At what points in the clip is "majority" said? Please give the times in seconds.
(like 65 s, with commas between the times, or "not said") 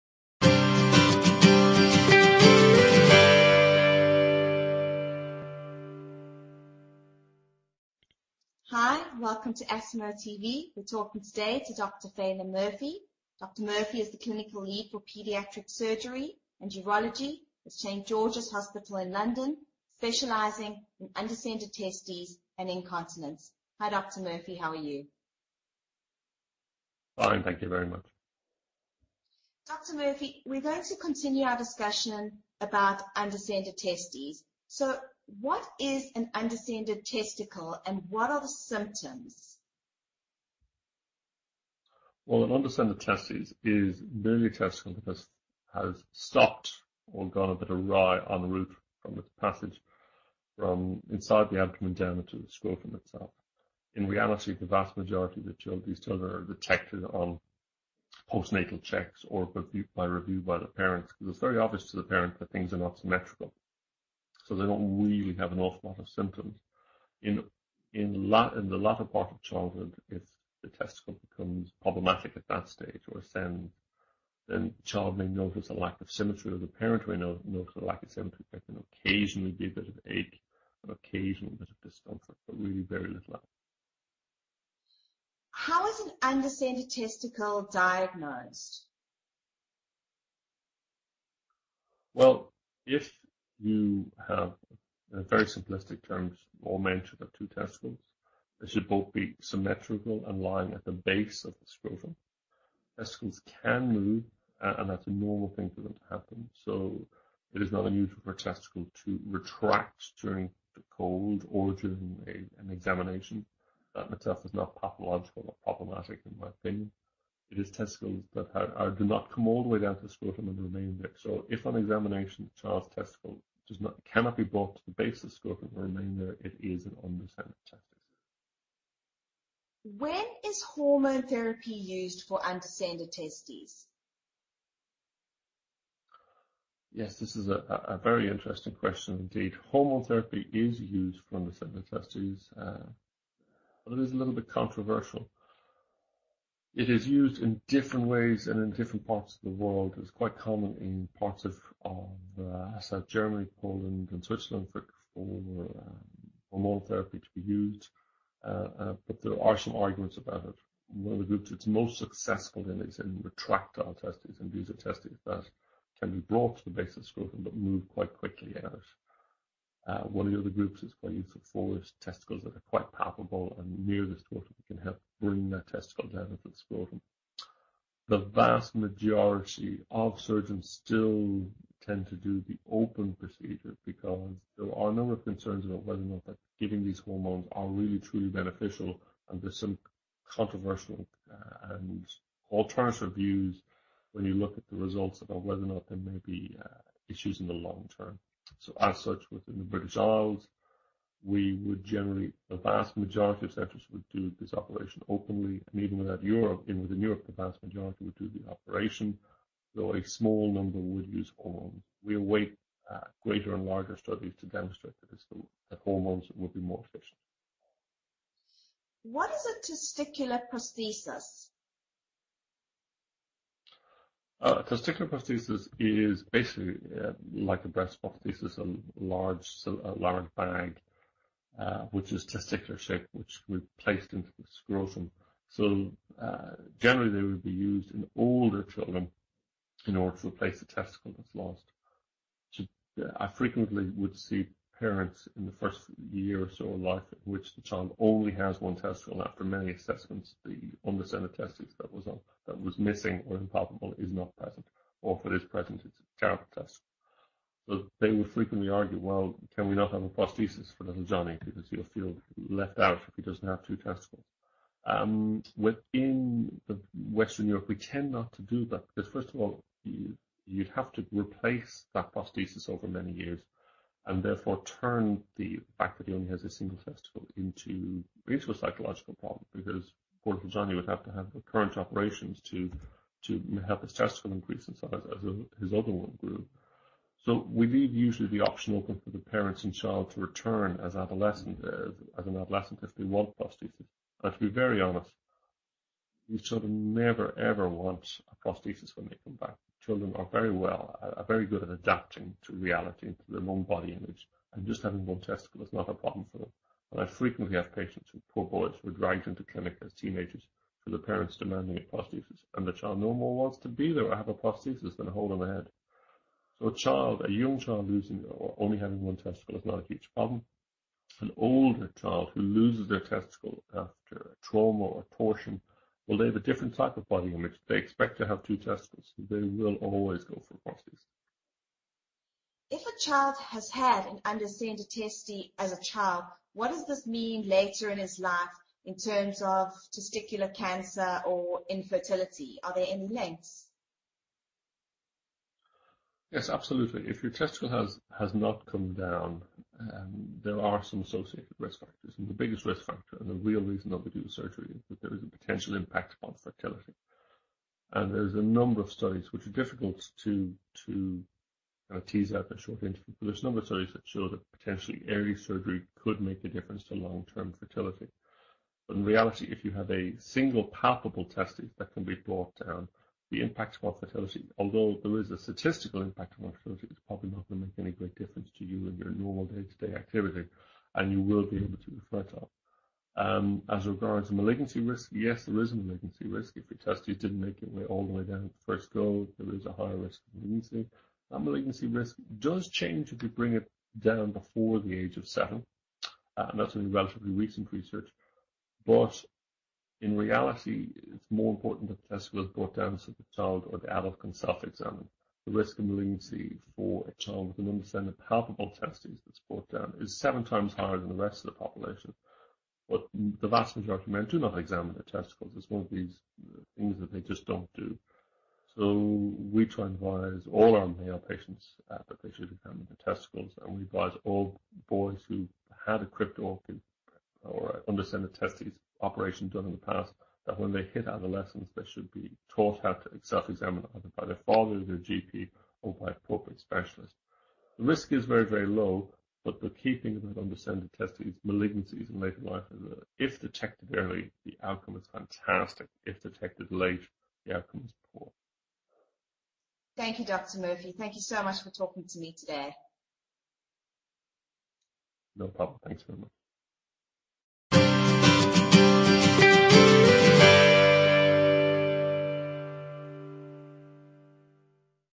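54 s, 178 s, 202 s, 207 s, 413 s.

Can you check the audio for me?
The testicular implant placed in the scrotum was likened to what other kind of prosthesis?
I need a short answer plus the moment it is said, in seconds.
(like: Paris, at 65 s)
Breast prosthesis, at 227 s.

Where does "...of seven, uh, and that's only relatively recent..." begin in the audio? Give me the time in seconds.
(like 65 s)
395 s.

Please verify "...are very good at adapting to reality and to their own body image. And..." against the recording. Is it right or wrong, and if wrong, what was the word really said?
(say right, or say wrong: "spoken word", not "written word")
right.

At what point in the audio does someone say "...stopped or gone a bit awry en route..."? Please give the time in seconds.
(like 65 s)
46 s.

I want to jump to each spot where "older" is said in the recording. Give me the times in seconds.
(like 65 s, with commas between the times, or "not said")
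238 s, 321 s.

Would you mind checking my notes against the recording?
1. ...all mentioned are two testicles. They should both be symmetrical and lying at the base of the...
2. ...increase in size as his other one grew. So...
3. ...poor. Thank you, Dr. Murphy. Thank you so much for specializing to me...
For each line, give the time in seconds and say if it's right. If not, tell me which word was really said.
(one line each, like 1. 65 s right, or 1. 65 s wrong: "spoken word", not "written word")
1. 96 s right
2. 284 s right
3. 448 s wrong: "talking", not "specializing".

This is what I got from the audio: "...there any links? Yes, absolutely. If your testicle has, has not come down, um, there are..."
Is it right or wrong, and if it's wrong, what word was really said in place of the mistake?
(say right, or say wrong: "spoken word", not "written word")
right.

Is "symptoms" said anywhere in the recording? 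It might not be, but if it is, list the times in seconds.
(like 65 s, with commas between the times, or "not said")
38 s, 66 s.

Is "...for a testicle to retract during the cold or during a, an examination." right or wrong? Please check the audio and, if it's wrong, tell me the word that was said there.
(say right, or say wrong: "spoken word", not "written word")
right.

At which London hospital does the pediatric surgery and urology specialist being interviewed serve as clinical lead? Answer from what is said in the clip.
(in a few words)
St George's Hospital.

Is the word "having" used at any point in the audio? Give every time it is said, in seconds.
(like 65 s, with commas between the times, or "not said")
304 s, 318 s.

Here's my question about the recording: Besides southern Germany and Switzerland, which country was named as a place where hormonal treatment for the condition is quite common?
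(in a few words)
Poland.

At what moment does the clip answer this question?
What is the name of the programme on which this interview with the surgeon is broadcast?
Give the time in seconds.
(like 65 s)
9 s.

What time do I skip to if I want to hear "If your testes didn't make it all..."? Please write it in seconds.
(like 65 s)
386 s.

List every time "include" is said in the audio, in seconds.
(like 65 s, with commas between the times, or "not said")
not said.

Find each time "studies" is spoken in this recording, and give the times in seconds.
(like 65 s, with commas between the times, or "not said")
213 s, 358 s, 363 s.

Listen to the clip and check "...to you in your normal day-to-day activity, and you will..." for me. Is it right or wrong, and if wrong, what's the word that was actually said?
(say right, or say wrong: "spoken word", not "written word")
right.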